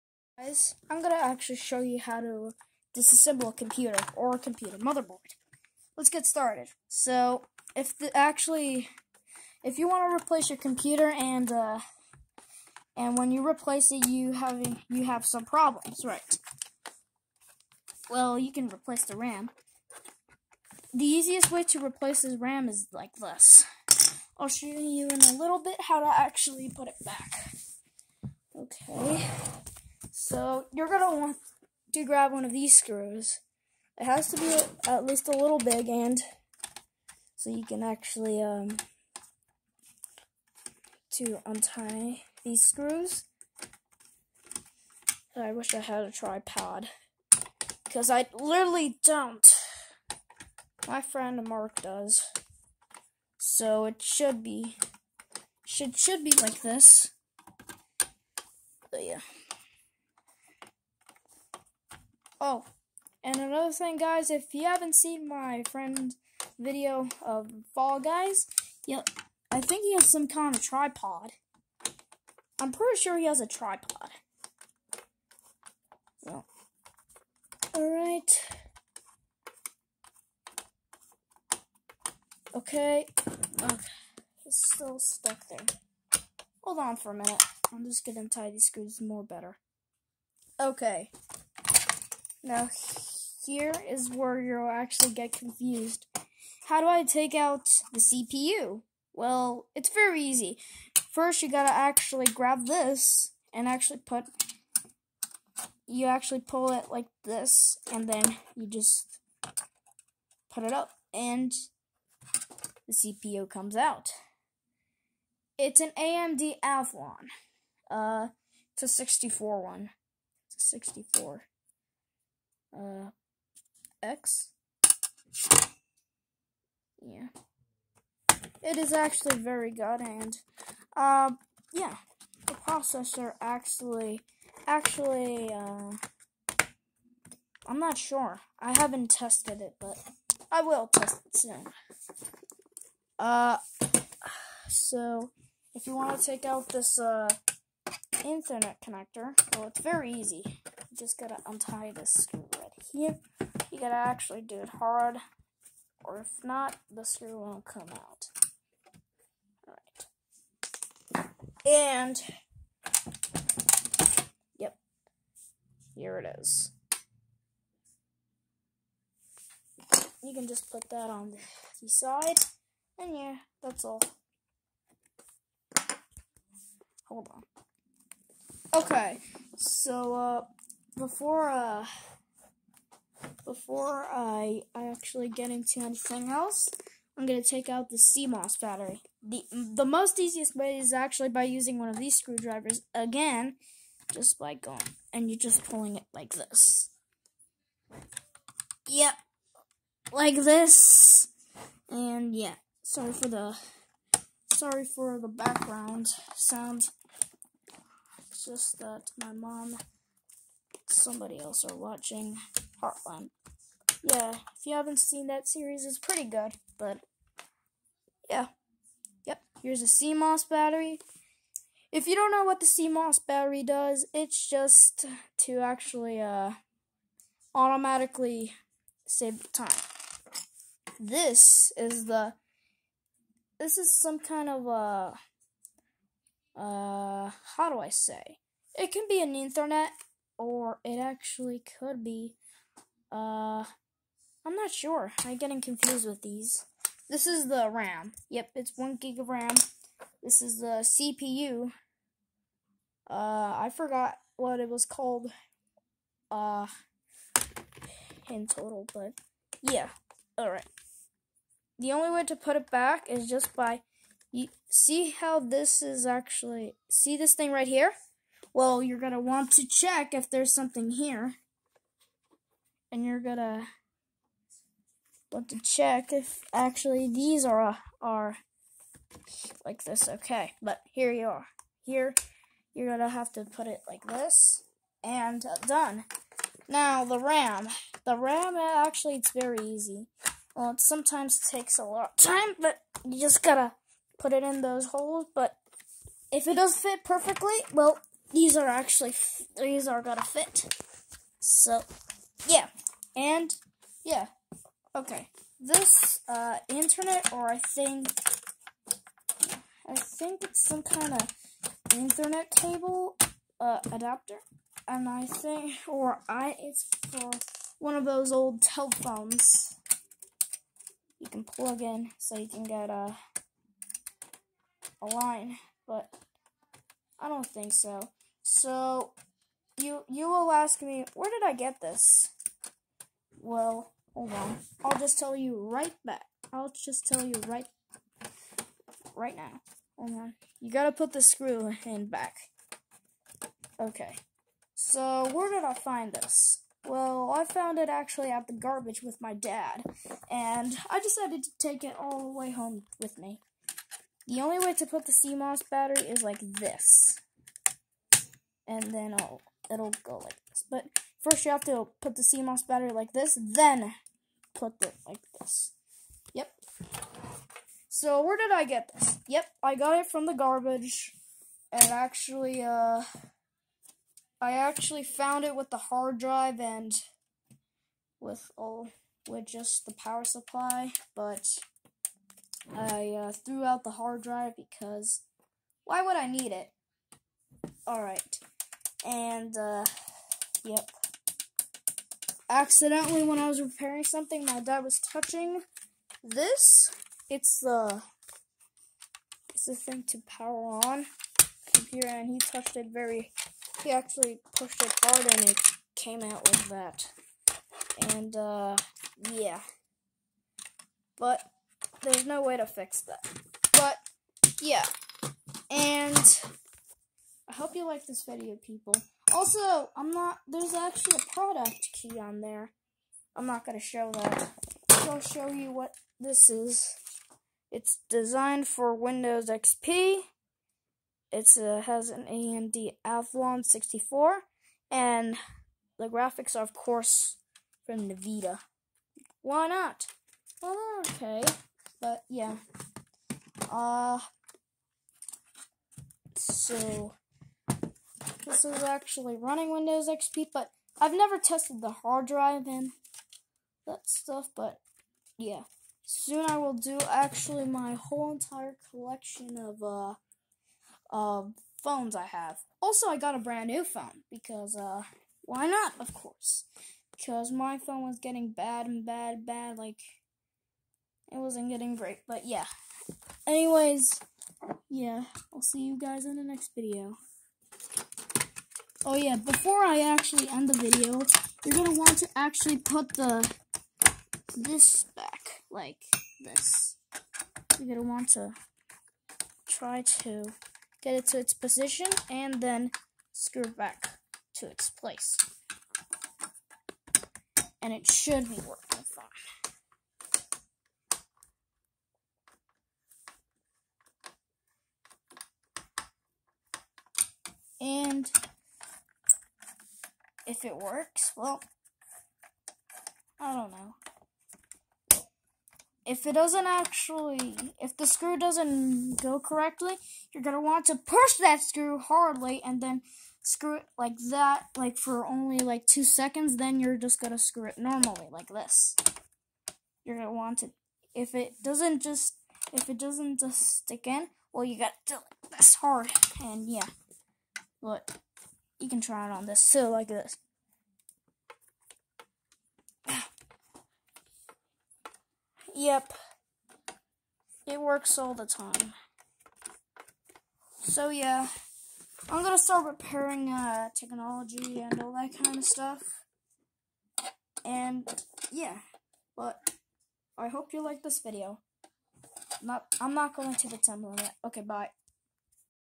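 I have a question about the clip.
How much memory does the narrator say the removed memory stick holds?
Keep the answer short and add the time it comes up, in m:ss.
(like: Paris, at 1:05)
1 gig, at 4:08.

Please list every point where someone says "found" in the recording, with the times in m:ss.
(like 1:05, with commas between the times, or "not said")
5:47, 6:15.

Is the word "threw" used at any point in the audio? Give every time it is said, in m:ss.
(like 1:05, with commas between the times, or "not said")
6:23.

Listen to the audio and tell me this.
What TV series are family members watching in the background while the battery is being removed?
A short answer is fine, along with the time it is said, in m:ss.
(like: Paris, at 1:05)
Heartland, at 3:32.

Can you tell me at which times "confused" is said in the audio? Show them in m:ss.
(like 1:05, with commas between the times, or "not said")
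1:35, 4:05.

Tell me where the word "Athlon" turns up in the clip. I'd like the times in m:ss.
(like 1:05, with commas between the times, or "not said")
1:56, 7:13.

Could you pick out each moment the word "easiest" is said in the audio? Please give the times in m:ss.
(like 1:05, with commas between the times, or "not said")
0:21, 3:10.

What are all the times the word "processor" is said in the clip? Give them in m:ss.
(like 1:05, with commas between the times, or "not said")
2:12.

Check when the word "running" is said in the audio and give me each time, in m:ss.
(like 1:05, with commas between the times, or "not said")
7:29.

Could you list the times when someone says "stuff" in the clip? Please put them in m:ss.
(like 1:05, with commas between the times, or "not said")
7:34, 9:15.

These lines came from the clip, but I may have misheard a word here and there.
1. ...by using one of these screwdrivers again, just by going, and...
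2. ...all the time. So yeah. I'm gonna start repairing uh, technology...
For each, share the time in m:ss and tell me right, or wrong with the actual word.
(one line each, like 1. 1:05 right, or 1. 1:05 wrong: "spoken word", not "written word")
1. 3:11 right
2. 9:08 right.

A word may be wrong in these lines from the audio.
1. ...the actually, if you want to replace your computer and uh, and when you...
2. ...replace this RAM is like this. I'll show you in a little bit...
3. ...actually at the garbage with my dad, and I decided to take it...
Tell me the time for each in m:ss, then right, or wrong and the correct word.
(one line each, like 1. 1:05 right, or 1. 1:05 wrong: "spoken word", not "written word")
1. 0:07 right
2. 0:21 right
3. 5:47 right.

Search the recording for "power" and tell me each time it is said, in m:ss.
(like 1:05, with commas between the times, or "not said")
6:19, 6:40.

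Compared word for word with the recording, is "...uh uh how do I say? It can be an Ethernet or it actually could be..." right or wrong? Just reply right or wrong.
right.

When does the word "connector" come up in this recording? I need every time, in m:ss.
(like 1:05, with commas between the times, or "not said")
2:28.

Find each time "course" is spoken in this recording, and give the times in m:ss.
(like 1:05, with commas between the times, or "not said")
7:16, 7:46.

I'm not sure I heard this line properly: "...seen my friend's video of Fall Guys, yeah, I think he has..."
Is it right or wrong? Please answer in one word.
right.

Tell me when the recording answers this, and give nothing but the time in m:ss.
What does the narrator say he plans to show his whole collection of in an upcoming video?
7:41.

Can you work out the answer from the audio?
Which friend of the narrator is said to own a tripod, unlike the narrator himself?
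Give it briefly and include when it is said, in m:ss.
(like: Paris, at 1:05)
Mark, at 0:51.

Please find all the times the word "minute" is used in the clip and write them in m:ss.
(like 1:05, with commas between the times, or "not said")
1:27.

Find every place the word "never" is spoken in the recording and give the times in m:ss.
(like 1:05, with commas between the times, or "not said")
7:31.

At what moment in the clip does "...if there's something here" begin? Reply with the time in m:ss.
4:30.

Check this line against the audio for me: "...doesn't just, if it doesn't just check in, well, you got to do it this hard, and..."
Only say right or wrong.
wrong.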